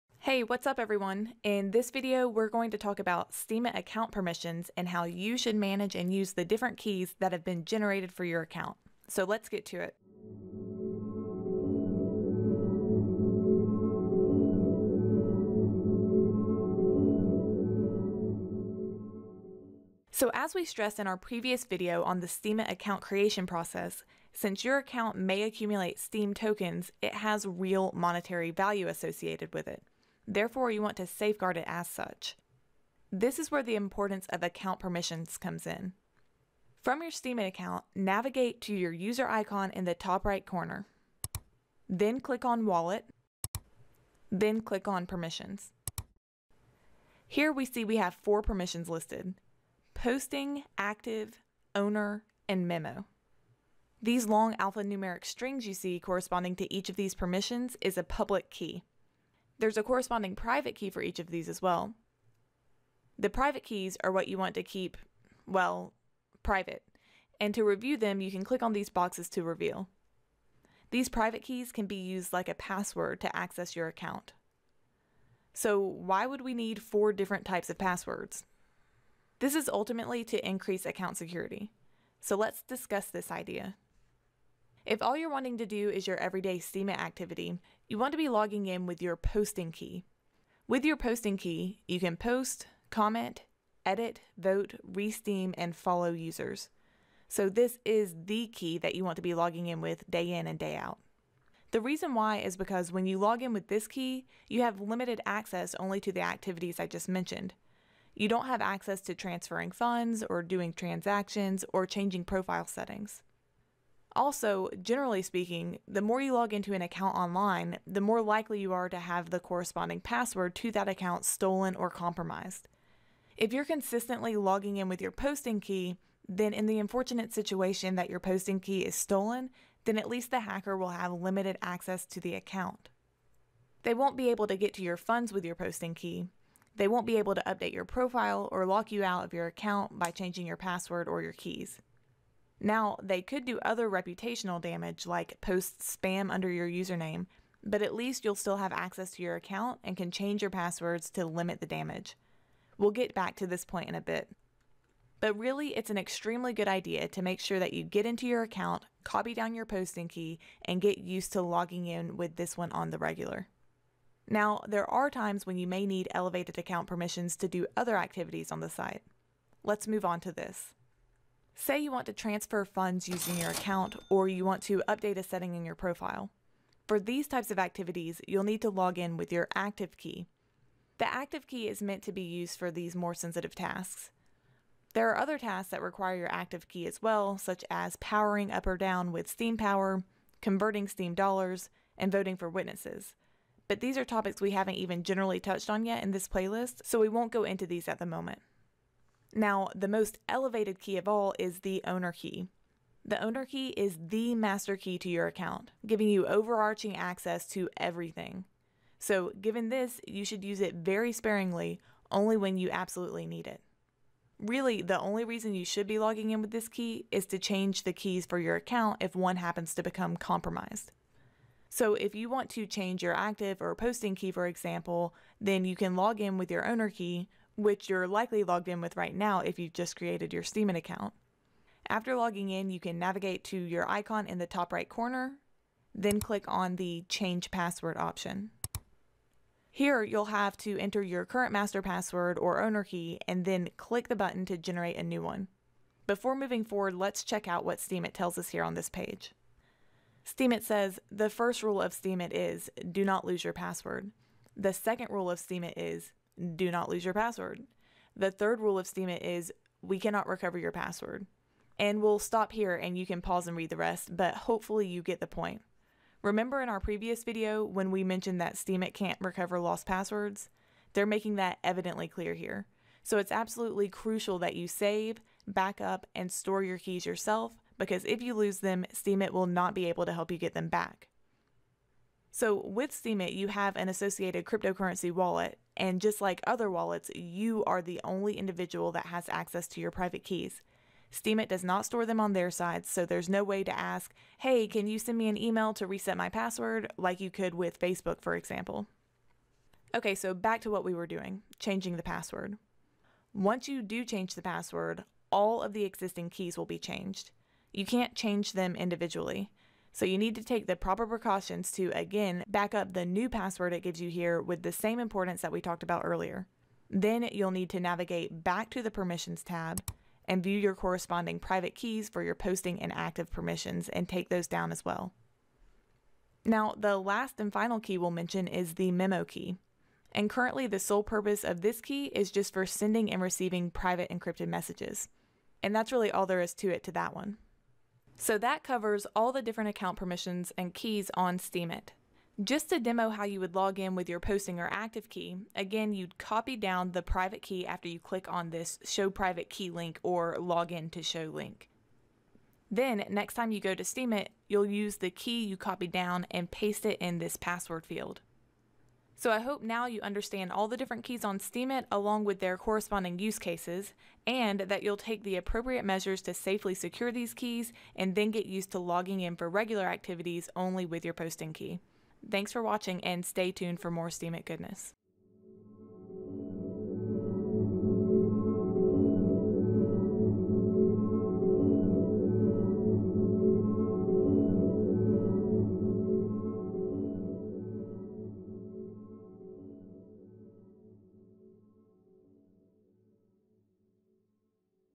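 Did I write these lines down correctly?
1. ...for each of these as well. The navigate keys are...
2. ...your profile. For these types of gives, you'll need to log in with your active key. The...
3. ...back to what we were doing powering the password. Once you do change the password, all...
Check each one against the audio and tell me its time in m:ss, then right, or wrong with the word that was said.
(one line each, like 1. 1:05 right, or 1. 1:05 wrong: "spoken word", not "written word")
1. 1:00 wrong: "private", not "navigate"
2. 2:55 wrong: "activities", not "gives"
3. 5:00 wrong: "changing", not "powering".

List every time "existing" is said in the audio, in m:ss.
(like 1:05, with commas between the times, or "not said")
5:05.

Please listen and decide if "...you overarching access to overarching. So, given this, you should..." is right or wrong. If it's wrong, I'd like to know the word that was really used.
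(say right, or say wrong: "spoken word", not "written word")
wrong: "everything", not "overarching".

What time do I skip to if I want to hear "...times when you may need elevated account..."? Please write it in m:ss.
2:45.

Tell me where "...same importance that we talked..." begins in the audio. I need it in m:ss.
5:14.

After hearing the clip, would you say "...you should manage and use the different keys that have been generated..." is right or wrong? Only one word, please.
right.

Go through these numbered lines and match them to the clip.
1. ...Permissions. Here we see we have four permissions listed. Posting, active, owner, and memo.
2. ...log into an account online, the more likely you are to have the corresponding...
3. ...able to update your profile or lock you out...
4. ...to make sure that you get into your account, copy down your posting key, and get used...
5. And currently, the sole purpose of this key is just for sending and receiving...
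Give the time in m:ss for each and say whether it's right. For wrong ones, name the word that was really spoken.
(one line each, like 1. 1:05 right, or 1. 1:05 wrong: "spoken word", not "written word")
1. 0:45 right
2. 1:56 right
3. 2:17 right
4. 2:37 right
5. 5:30 right.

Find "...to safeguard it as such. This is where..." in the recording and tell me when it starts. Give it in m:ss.
0:30.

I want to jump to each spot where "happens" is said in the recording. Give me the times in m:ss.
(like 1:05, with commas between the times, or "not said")
3:39.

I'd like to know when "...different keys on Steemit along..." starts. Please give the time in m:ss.
6:00.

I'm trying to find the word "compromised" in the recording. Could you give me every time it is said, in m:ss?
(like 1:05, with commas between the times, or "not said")
2:01, 3:40.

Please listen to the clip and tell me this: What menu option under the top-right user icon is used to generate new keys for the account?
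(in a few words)
Change Password.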